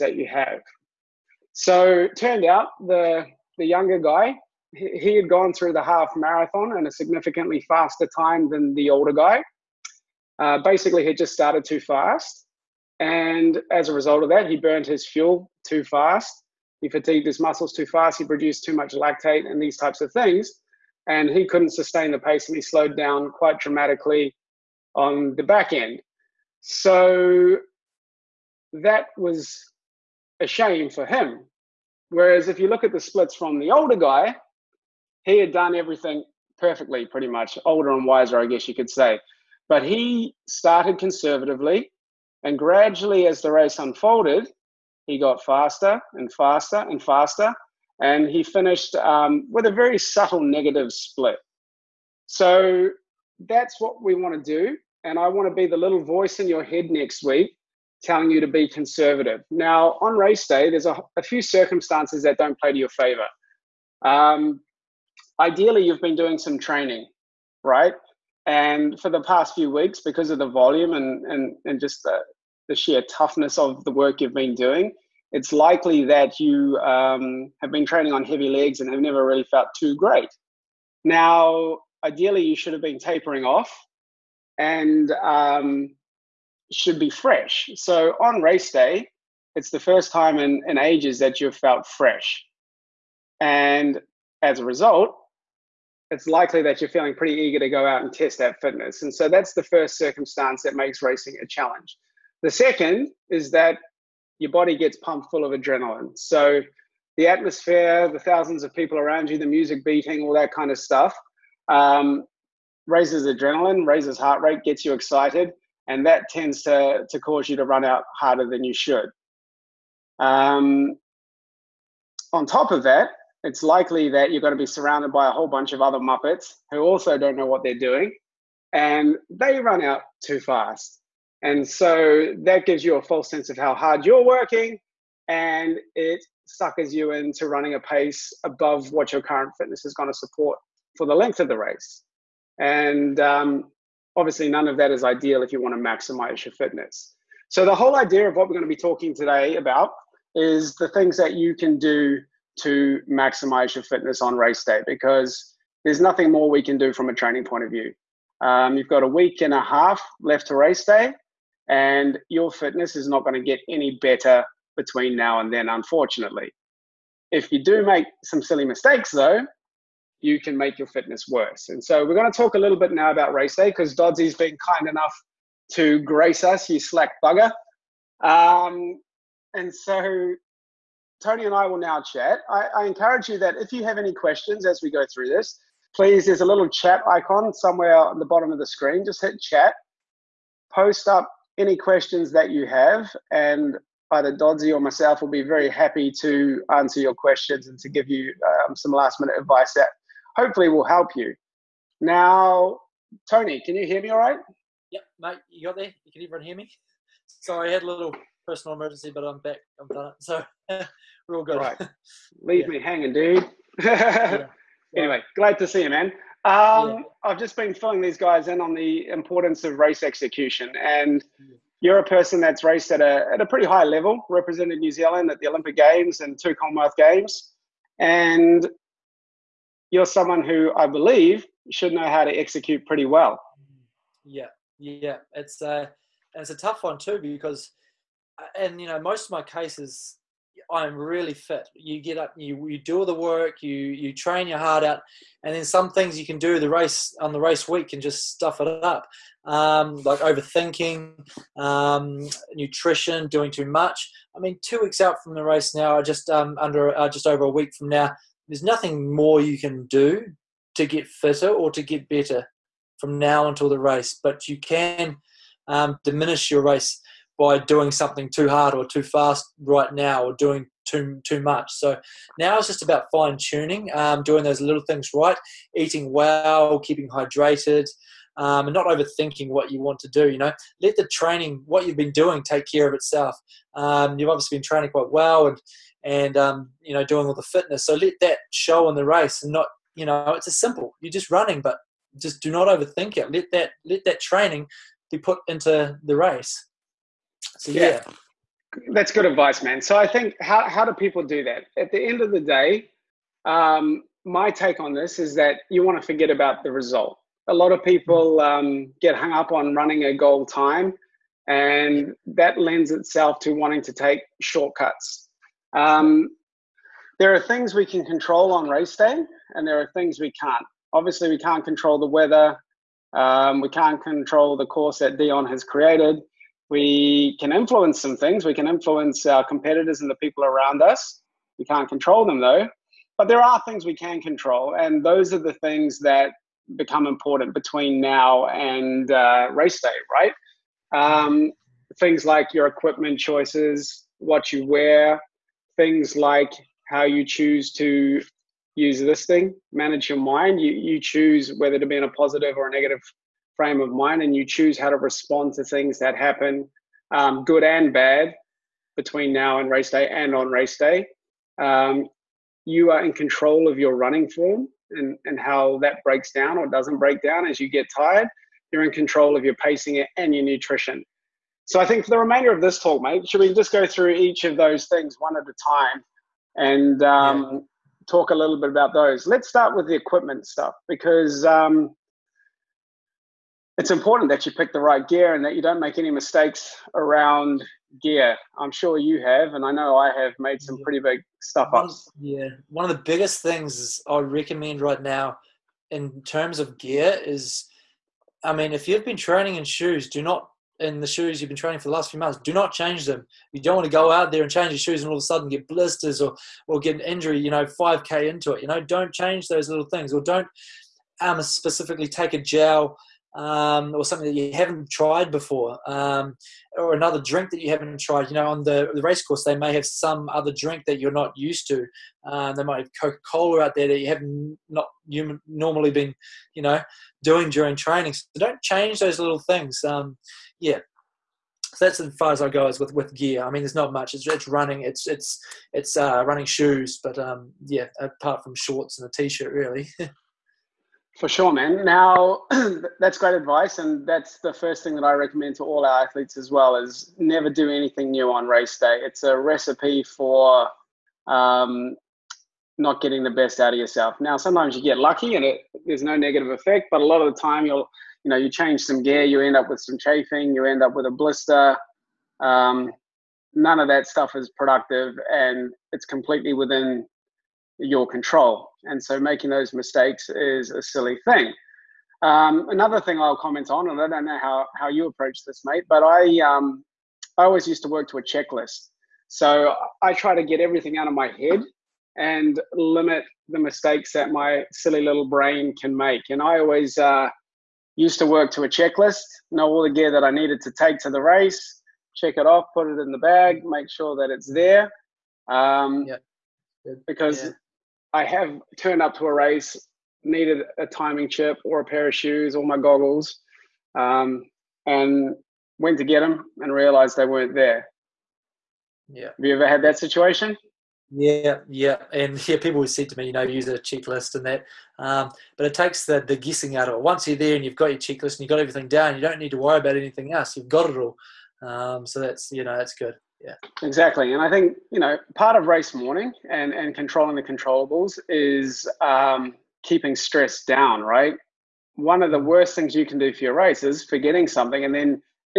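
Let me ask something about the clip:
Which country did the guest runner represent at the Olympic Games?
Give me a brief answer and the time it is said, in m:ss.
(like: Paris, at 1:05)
New Zealand, at 3:44.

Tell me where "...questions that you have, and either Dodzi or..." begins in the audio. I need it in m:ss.
3:11.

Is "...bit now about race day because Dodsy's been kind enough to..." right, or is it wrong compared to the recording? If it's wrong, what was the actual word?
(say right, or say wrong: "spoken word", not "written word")
right.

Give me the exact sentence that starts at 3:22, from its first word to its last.
Now, Tony, can you hear me all right?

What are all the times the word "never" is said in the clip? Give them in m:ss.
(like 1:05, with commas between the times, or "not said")
1:19, 7:27.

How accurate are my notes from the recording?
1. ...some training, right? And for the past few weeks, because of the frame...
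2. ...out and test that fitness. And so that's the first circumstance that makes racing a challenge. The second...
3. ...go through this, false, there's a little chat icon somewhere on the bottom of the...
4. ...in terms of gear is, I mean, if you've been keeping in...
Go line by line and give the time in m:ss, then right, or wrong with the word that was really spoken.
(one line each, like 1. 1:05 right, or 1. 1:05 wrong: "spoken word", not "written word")
1. 1:06 wrong: "volume", not "frame"
2. 1:37 right
3. 3:04 wrong: "please", not "false"
4. 6:35 wrong: "training", not "keeping".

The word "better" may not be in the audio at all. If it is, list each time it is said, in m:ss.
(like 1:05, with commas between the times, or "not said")
2:44, 4:22.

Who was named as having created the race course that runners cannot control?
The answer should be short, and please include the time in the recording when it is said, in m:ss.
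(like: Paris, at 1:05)
Dion, at 5:25.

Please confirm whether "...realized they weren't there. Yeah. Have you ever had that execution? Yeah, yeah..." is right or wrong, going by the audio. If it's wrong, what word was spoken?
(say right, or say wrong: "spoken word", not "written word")
wrong: "situation", not "execution".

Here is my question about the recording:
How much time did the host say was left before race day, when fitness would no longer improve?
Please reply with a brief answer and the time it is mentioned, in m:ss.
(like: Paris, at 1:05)
a week and a half, at 2:39.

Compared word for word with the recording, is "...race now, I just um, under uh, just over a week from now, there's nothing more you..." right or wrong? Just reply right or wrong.
right.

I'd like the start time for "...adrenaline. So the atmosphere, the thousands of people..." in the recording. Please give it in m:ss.
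1:45.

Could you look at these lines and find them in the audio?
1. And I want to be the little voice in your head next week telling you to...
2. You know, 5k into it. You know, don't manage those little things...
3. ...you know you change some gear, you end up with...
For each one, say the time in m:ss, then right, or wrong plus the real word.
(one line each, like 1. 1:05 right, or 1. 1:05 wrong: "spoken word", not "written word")
1. 0:55 right
2. 6:47 wrong: "change", not "manage"
3. 7:38 right.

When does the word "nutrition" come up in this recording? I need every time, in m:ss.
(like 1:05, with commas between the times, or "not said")
4:12, 6:10.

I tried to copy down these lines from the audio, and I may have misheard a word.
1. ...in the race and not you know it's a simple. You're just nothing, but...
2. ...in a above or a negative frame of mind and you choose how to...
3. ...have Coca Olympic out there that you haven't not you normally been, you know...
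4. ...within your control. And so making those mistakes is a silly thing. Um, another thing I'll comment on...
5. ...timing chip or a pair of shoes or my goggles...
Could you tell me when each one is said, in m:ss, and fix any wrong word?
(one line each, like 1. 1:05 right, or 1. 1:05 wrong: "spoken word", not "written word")
1. 4:48 wrong: "running", not "nothing"
2. 5:51 wrong: "positive", not "above"
3. 7:02 wrong: "Cola", not "Olympic"
4. 7:46 right
5. 8:20 right.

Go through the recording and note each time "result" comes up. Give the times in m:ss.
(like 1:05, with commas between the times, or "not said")
0:13, 1:34, 5:06.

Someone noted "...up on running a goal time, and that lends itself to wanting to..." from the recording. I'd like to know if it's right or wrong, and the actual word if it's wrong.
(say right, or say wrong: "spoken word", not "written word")
right.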